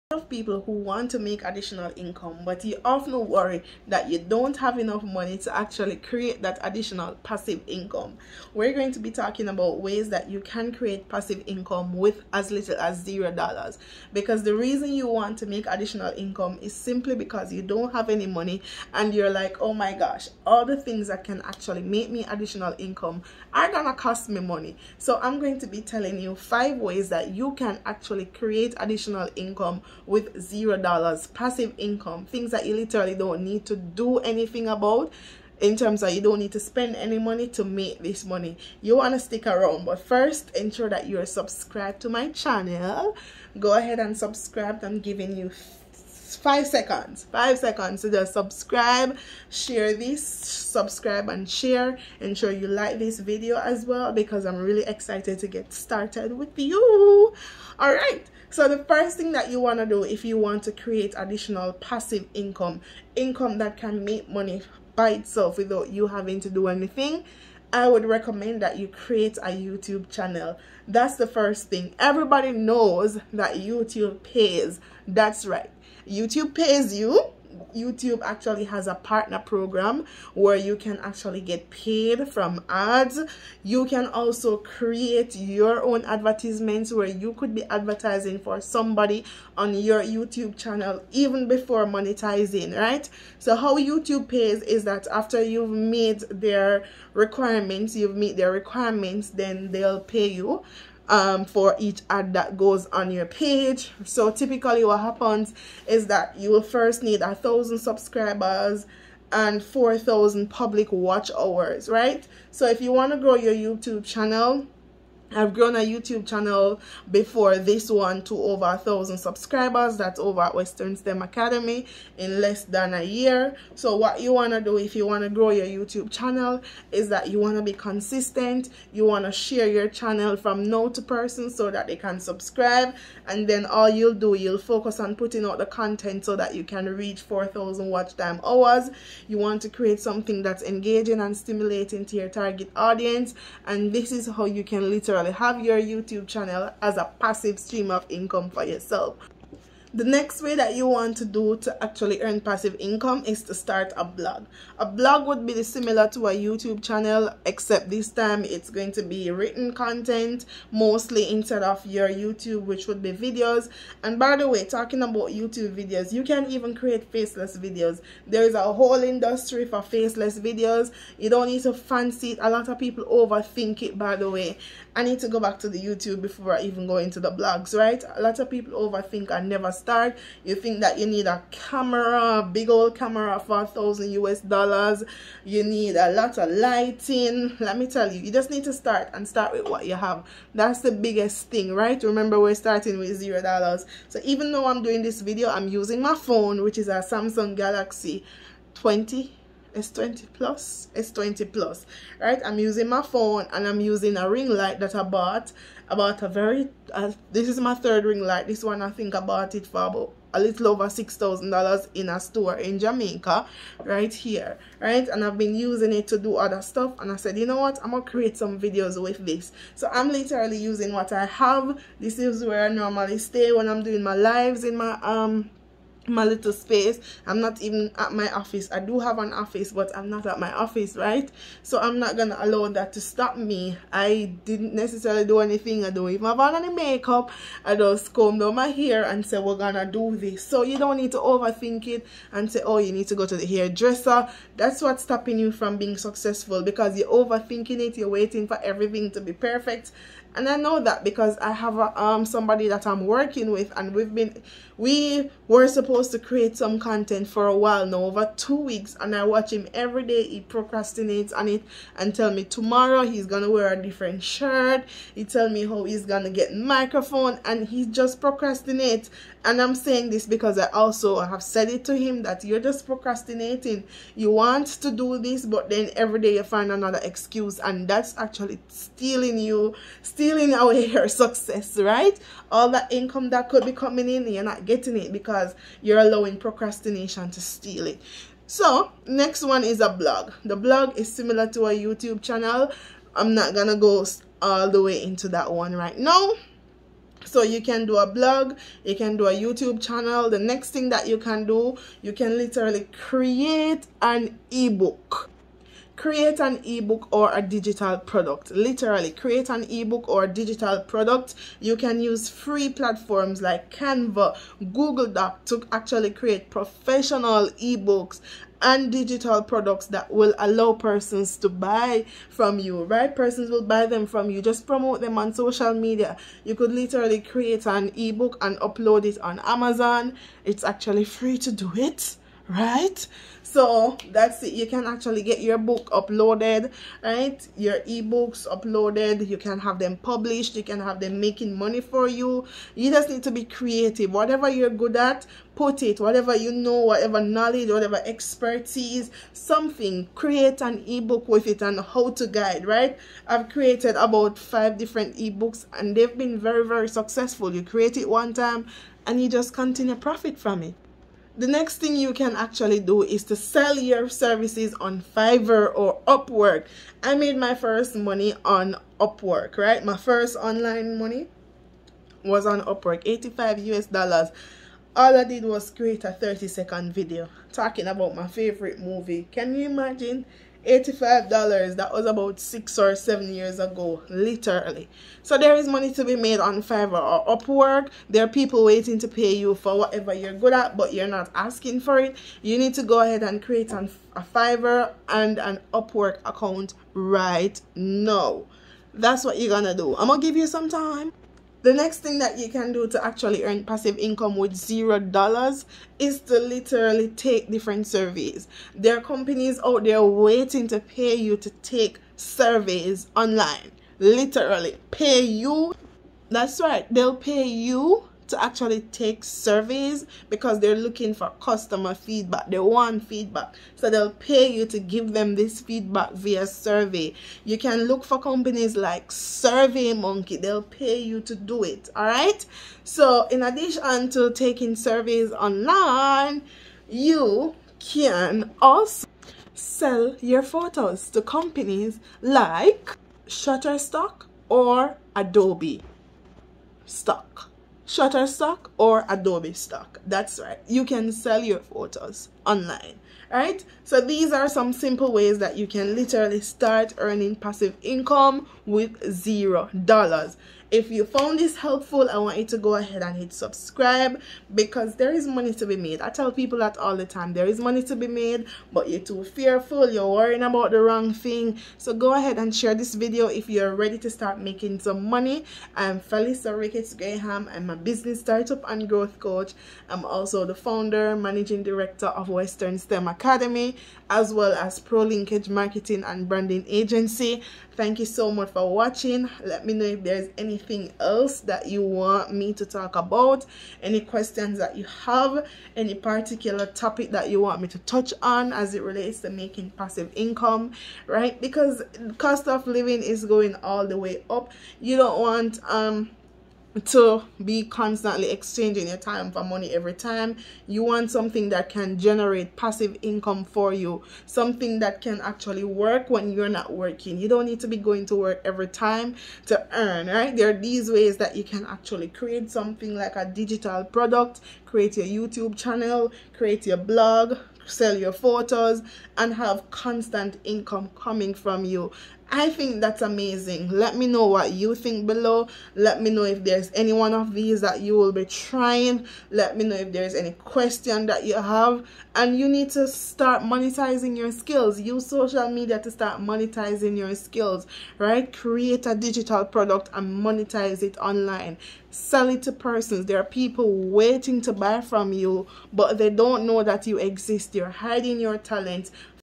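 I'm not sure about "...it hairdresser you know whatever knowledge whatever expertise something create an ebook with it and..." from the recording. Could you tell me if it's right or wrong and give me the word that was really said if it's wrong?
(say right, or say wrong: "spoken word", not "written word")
wrong: "whatever", not "hairdresser".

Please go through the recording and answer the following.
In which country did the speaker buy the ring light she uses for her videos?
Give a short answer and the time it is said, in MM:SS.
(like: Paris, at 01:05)
Jamaica, at 03:32.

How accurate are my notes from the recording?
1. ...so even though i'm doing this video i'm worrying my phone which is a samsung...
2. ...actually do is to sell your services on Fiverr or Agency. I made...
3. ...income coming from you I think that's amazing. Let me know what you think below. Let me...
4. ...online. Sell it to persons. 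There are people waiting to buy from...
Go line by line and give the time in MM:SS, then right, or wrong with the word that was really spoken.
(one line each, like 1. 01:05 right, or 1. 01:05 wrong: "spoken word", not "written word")
1. 03:14 wrong: "using", not "worrying"
2. 06:02 wrong: "Upwork", not "Agency"
3. 08:50 right
4. 09:10 right.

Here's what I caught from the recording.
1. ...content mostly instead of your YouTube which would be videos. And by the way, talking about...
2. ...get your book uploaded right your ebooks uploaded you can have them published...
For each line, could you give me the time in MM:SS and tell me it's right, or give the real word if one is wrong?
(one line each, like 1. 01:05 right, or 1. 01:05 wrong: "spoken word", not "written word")
1. 02:39 right
2. 05:35 right.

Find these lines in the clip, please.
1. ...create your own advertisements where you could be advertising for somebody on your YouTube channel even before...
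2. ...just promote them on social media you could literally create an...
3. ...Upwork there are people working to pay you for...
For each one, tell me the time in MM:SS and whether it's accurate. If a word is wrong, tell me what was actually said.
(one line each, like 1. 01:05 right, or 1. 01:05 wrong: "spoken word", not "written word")
1. 01:24 right
2. 05:24 right
3. 06:27 wrong: "waiting", not "working".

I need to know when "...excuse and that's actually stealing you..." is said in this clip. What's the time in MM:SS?
04:37.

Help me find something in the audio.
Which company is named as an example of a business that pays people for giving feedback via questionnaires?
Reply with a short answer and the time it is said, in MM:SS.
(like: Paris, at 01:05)
Survey Monkey, at 07:09.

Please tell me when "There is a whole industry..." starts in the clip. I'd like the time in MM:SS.
02:48.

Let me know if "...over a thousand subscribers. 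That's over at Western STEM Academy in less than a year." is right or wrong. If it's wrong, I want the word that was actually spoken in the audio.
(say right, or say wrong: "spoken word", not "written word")
right.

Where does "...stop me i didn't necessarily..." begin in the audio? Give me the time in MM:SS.
03:53.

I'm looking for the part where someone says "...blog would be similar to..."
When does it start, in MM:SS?
02:34.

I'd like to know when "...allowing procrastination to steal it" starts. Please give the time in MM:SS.
04:45.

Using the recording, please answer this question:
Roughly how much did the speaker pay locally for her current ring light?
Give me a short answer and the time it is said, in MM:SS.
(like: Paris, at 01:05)
$6,000, at 03:30.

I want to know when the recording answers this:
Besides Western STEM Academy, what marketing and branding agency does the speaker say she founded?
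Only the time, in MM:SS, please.
08:04.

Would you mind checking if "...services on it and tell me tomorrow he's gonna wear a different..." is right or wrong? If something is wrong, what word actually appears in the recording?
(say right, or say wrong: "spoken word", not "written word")
wrong: "procrastinates", not "services".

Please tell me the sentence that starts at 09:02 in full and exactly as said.
And you need to start monetizing your skills.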